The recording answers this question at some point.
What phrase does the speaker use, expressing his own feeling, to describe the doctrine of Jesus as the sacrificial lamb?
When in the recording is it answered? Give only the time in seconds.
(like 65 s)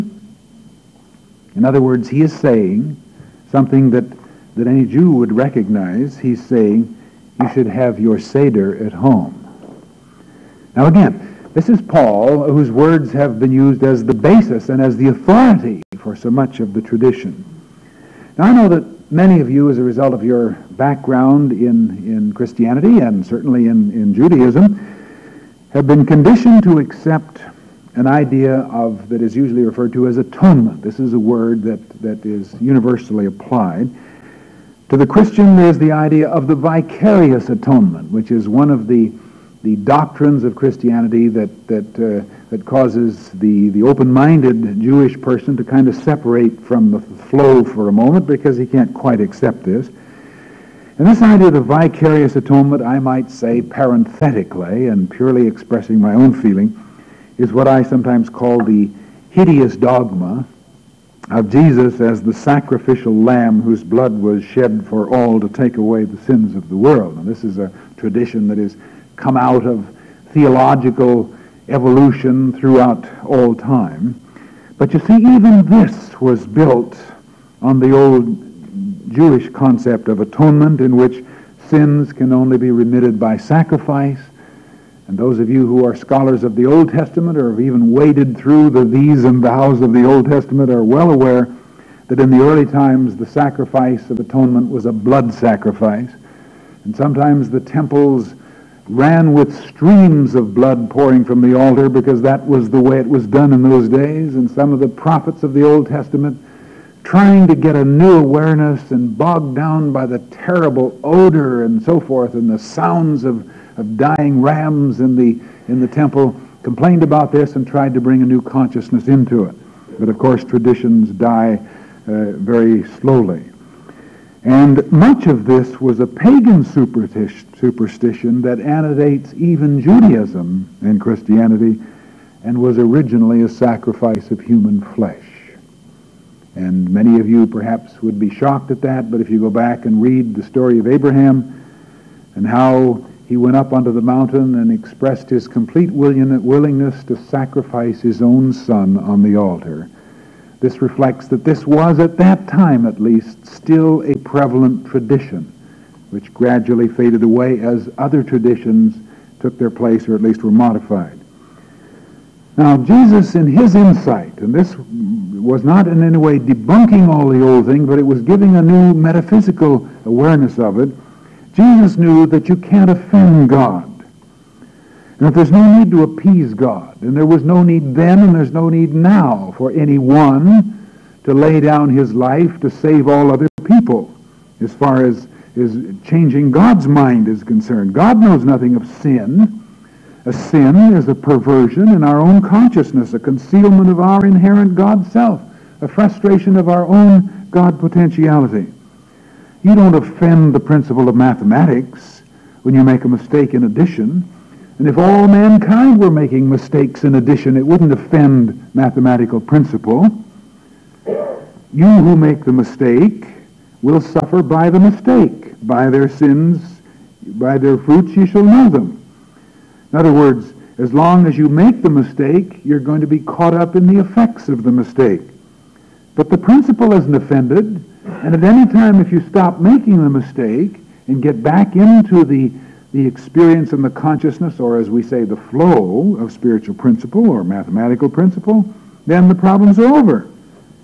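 59 s.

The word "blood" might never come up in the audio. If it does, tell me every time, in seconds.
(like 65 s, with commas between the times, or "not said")
63 s, 94 s, 100 s.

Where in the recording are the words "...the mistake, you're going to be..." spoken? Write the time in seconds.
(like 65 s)
221 s.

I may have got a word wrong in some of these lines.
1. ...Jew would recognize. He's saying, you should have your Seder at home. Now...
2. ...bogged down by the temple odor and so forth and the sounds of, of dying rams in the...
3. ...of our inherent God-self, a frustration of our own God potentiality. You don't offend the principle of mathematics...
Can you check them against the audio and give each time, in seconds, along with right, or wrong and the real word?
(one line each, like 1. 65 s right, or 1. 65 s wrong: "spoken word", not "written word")
1. 4 s right
2. 109 s wrong: "terrible", not "temple"
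3. 193 s right.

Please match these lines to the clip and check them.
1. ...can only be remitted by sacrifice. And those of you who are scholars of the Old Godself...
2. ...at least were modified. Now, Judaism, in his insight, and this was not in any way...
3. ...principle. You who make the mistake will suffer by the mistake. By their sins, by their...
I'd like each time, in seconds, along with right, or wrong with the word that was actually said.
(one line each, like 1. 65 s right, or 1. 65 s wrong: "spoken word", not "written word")
1. 82 s wrong: "Testament", not "Godself"
2. 160 s wrong: "Jesus", not "Judaism"
3. 209 s right.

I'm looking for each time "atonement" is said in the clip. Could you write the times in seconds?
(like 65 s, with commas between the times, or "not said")
30 s, 37 s, 52 s, 80 s, 94 s.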